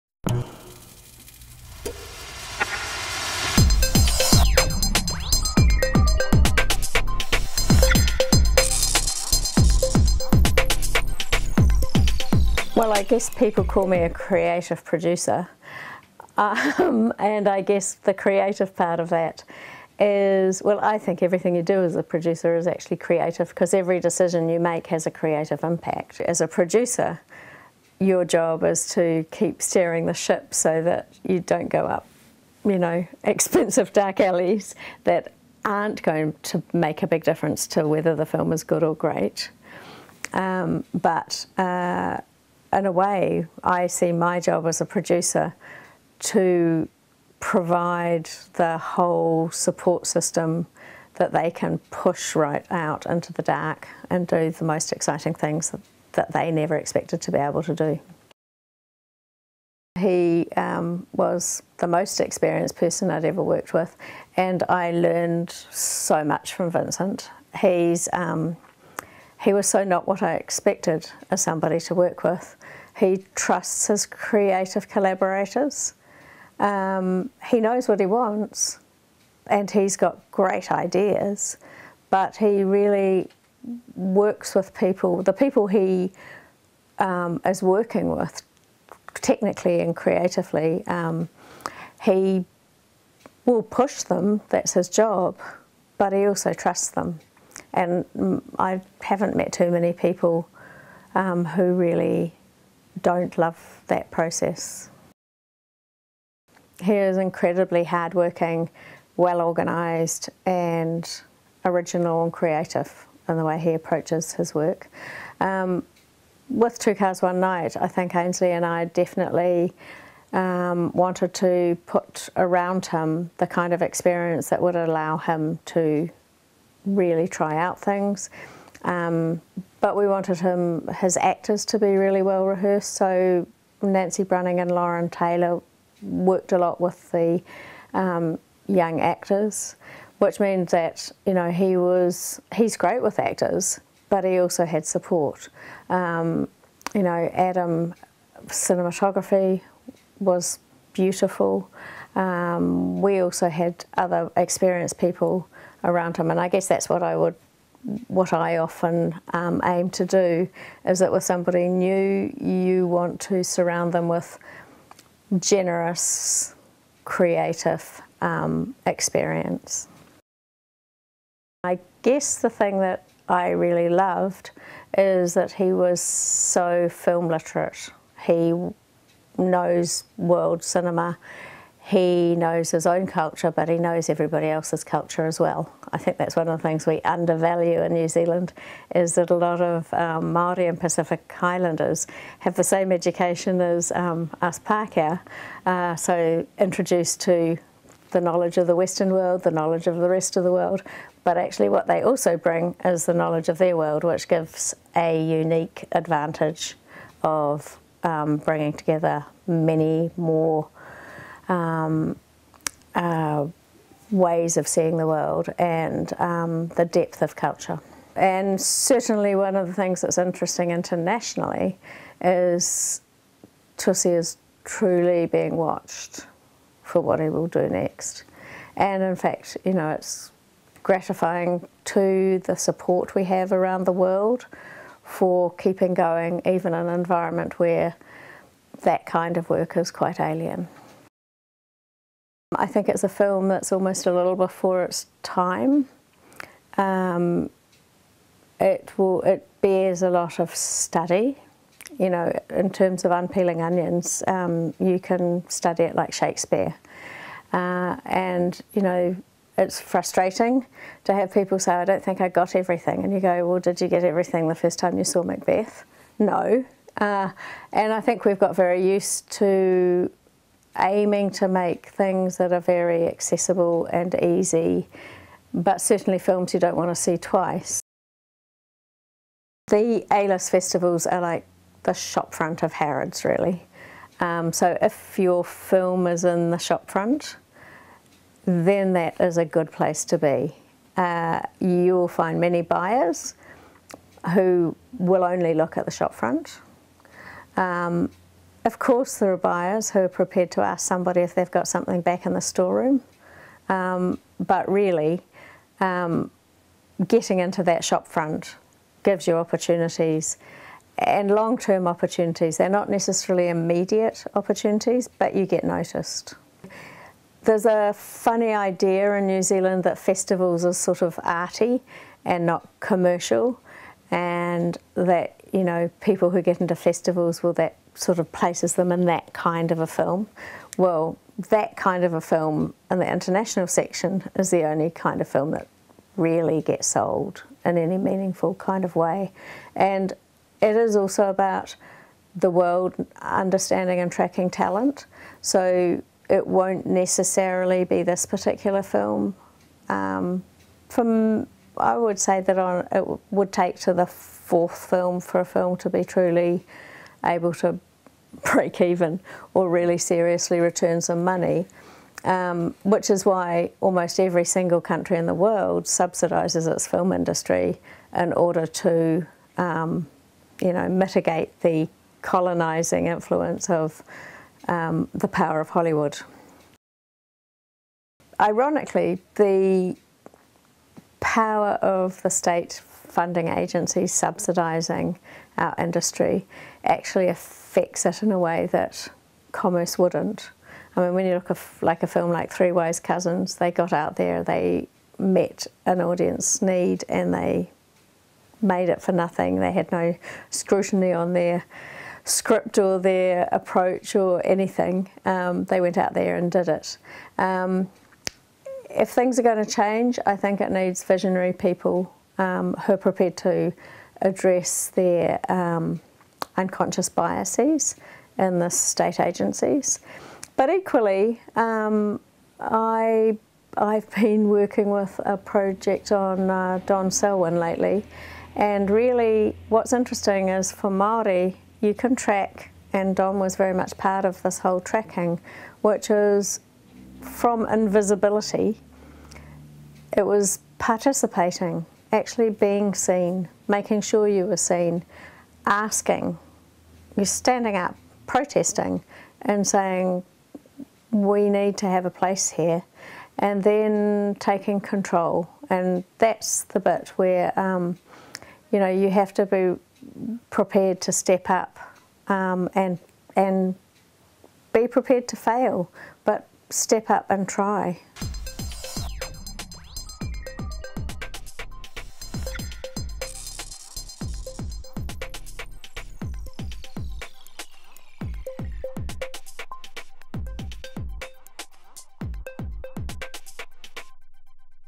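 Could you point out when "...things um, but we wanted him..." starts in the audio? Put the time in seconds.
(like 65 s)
127 s.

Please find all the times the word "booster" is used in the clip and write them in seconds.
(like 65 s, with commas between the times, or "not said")
not said.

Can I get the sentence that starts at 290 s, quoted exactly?
Uh, you'll find many buyers who will only look at the shopfront.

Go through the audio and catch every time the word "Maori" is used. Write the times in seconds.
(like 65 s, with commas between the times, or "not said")
190 s.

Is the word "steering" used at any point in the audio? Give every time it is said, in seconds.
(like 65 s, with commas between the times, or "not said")
29 s.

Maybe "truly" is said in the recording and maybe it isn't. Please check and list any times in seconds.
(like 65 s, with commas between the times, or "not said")
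224 s, 356 s.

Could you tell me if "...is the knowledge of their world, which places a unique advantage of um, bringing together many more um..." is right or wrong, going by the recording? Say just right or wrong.
wrong.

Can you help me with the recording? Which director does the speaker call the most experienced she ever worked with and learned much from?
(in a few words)
Vincent.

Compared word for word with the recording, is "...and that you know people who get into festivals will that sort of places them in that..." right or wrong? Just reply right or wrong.
right.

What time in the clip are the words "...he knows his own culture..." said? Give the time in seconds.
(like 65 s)
181 s.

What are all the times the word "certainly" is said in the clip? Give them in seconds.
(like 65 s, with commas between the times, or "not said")
218 s, 275 s.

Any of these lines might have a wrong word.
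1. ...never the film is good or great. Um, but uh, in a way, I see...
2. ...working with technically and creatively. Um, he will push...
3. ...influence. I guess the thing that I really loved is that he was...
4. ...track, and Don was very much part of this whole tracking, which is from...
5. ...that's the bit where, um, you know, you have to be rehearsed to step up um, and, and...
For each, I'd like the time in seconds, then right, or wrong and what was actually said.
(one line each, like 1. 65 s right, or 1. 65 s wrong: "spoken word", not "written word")
1. 37 s wrong: "whether", not "never"
2. 87 s right
3. 168 s wrong: "experience", not "influence"
4. 432 s right
5. 456 s wrong: "prepared", not "rehearsed".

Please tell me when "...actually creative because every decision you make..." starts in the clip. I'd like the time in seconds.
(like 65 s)
22 s.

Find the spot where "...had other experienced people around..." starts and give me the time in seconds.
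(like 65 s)
153 s.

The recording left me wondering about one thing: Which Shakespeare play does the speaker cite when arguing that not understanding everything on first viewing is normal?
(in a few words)
Macbeth.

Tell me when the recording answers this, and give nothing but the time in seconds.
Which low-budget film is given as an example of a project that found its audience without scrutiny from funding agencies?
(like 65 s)
392 s.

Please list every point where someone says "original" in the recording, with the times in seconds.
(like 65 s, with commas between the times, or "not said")
111 s.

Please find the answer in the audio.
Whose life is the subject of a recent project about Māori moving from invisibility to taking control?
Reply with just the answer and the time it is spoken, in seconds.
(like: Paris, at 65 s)
Don Selwyn, at 426 s.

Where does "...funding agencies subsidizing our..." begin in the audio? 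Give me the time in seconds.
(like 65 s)
382 s.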